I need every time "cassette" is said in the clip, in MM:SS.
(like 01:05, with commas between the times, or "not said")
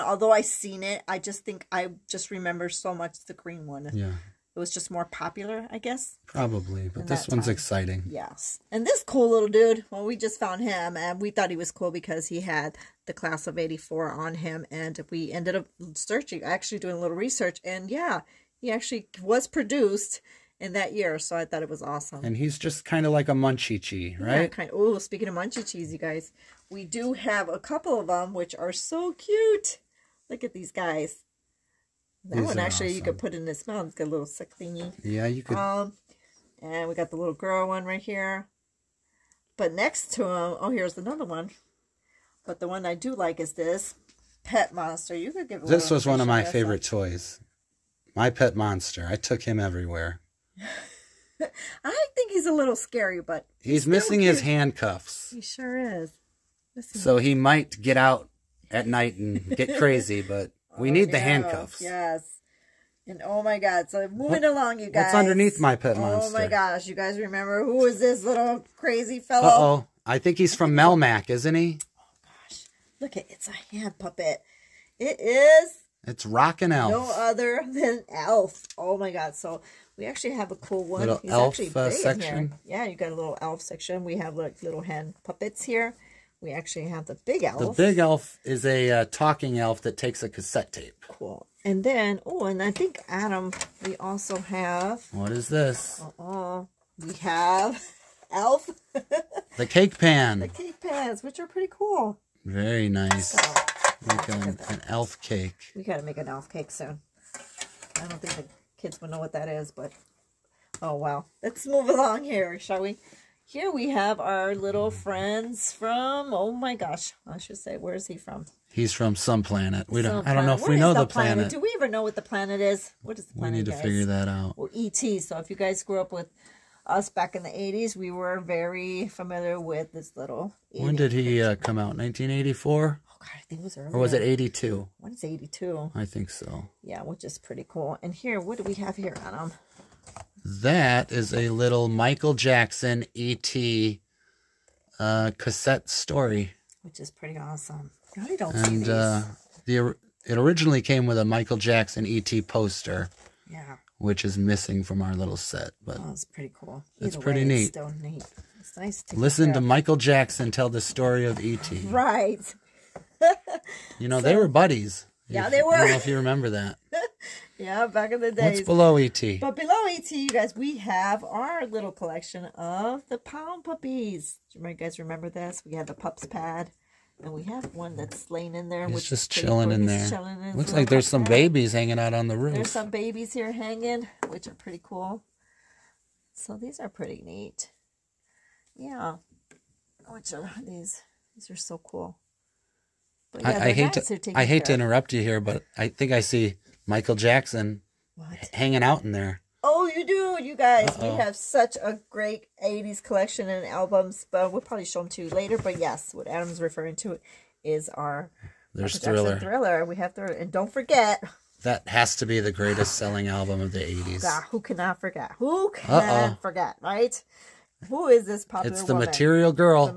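01:30, 02:25.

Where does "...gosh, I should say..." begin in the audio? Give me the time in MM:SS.
01:56.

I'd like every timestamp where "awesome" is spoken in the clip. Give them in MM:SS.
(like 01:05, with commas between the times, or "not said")
00:21, 00:32, 02:27.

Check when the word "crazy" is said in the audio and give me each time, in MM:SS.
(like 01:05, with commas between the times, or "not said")
00:59, 01:08.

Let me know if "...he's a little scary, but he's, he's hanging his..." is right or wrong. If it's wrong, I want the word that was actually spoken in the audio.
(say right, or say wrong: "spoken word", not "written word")
wrong: "missing", not "hanging".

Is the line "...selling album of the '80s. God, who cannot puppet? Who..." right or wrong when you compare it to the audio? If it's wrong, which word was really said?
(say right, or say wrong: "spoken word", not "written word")
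wrong: "forget", not "puppet".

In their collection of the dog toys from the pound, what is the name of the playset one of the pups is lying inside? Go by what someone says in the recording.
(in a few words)
pups pad.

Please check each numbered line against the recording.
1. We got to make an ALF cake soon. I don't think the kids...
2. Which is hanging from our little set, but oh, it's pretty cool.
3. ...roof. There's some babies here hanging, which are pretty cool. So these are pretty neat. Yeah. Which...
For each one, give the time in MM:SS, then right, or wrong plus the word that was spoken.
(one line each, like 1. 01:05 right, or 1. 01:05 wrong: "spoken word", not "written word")
1. 01:45 right
2. 02:33 wrong: "missing", not "hanging"
3. 03:02 right.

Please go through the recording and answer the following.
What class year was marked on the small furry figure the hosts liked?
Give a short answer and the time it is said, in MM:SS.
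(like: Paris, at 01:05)
84, at 00:13.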